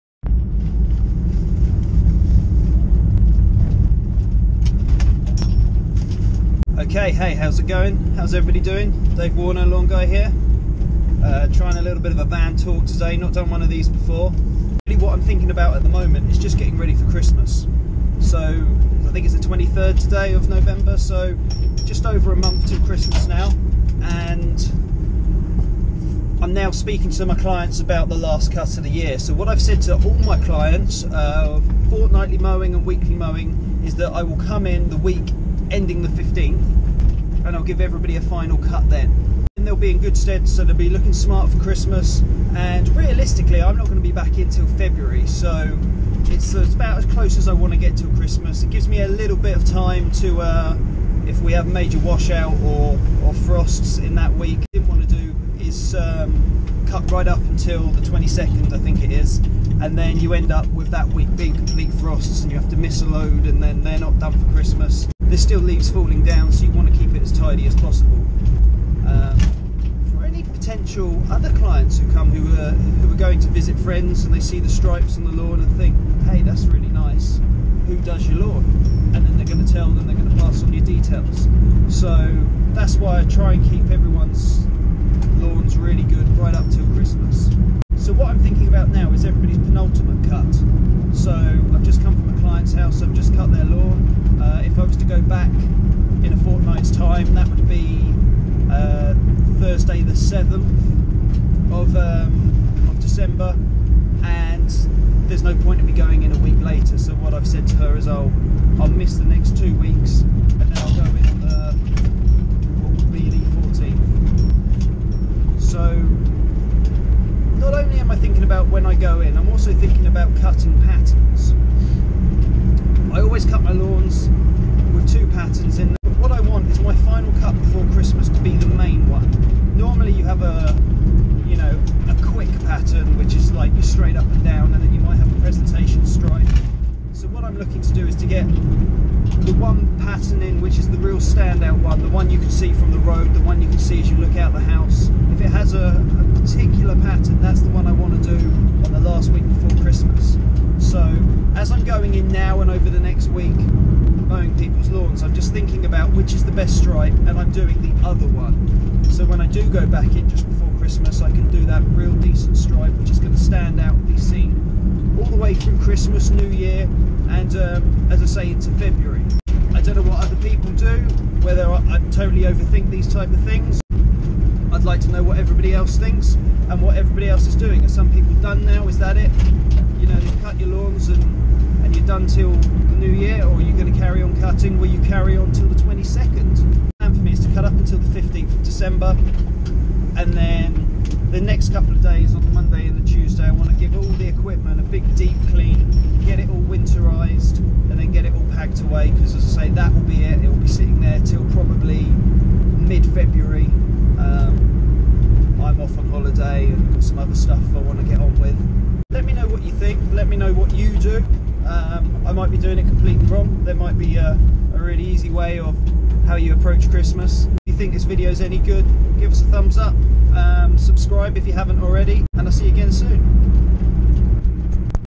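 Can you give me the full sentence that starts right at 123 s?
I always cut my lawns with two patterns in straight up and down and then you might have a presentation stride.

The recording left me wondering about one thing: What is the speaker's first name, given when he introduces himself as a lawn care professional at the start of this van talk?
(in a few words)
Dave.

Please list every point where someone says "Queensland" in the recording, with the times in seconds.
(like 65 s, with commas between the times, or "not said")
not said.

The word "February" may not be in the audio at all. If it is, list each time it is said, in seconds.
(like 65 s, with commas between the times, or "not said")
44 s, 168 s, 202 s.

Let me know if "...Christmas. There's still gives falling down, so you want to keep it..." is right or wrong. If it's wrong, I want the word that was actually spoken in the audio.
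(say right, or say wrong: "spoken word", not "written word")
wrong: "leaves", not "gives".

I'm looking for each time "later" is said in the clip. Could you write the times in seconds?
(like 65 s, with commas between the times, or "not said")
106 s.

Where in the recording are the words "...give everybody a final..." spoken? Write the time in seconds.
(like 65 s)
37 s.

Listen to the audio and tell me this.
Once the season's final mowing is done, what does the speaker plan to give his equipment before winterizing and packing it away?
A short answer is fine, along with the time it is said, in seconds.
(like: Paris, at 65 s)
a big deep clean, at 194 s.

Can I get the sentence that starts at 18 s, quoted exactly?
So, I think it's the 23rd today of November, so just over a month to Christmas now.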